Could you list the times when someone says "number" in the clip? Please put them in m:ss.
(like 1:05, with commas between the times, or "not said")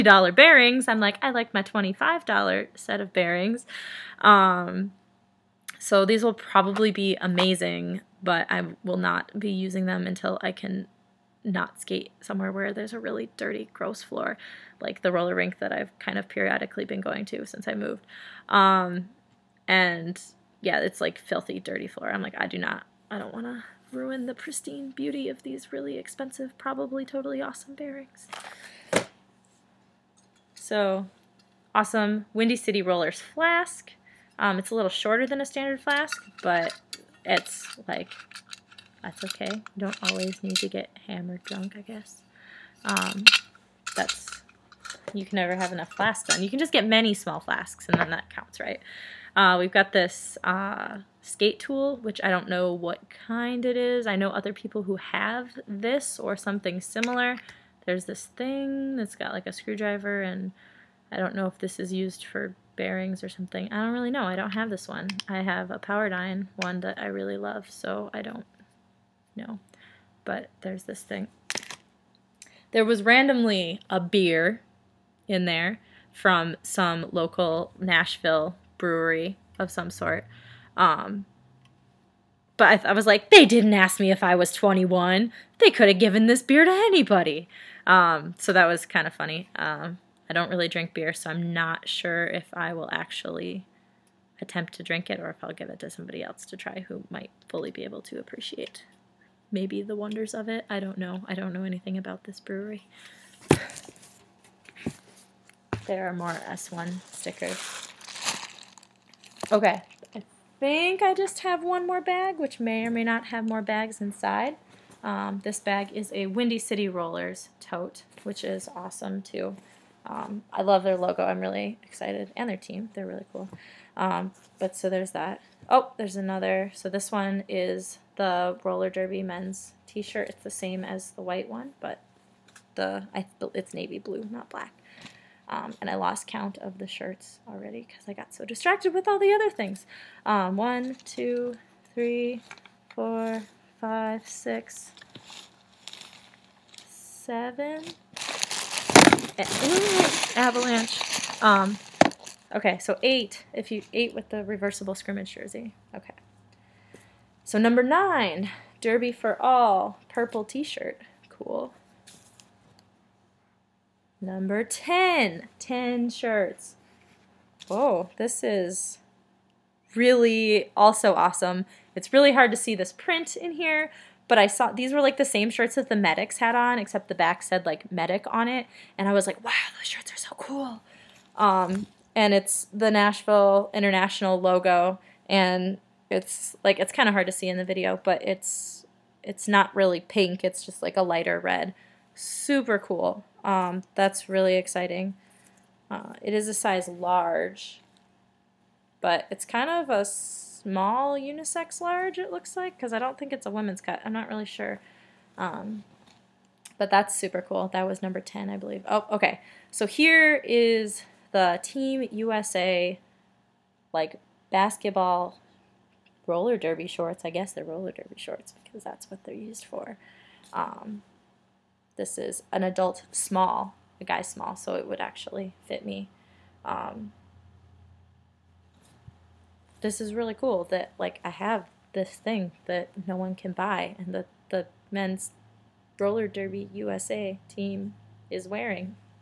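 2:37, 2:44, 3:28.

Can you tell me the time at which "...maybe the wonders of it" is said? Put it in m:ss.
1:39.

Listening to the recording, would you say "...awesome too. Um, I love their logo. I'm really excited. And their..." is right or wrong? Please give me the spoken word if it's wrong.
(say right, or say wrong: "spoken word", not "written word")
right.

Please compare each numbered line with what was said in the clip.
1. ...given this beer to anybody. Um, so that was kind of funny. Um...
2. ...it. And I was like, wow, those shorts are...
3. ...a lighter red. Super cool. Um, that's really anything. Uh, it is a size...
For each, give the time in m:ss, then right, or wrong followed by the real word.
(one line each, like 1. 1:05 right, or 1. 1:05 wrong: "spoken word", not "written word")
1. 1:25 right
2. 2:58 wrong: "shirts", not "shorts"
3. 3:10 wrong: "exciting", not "anything".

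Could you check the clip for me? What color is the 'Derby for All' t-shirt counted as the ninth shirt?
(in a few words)
Purple.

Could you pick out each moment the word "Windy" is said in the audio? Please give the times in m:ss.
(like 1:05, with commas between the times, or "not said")
0:32, 1:56.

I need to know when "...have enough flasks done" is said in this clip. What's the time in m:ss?
0:45.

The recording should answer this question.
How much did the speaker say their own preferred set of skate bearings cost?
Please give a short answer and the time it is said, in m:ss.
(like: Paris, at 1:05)
$25, at 0:01.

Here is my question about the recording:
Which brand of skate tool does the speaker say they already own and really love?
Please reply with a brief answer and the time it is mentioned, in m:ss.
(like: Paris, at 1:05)
Powerdyne, at 1:05.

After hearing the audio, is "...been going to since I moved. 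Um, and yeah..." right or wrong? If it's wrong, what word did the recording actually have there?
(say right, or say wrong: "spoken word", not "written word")
right.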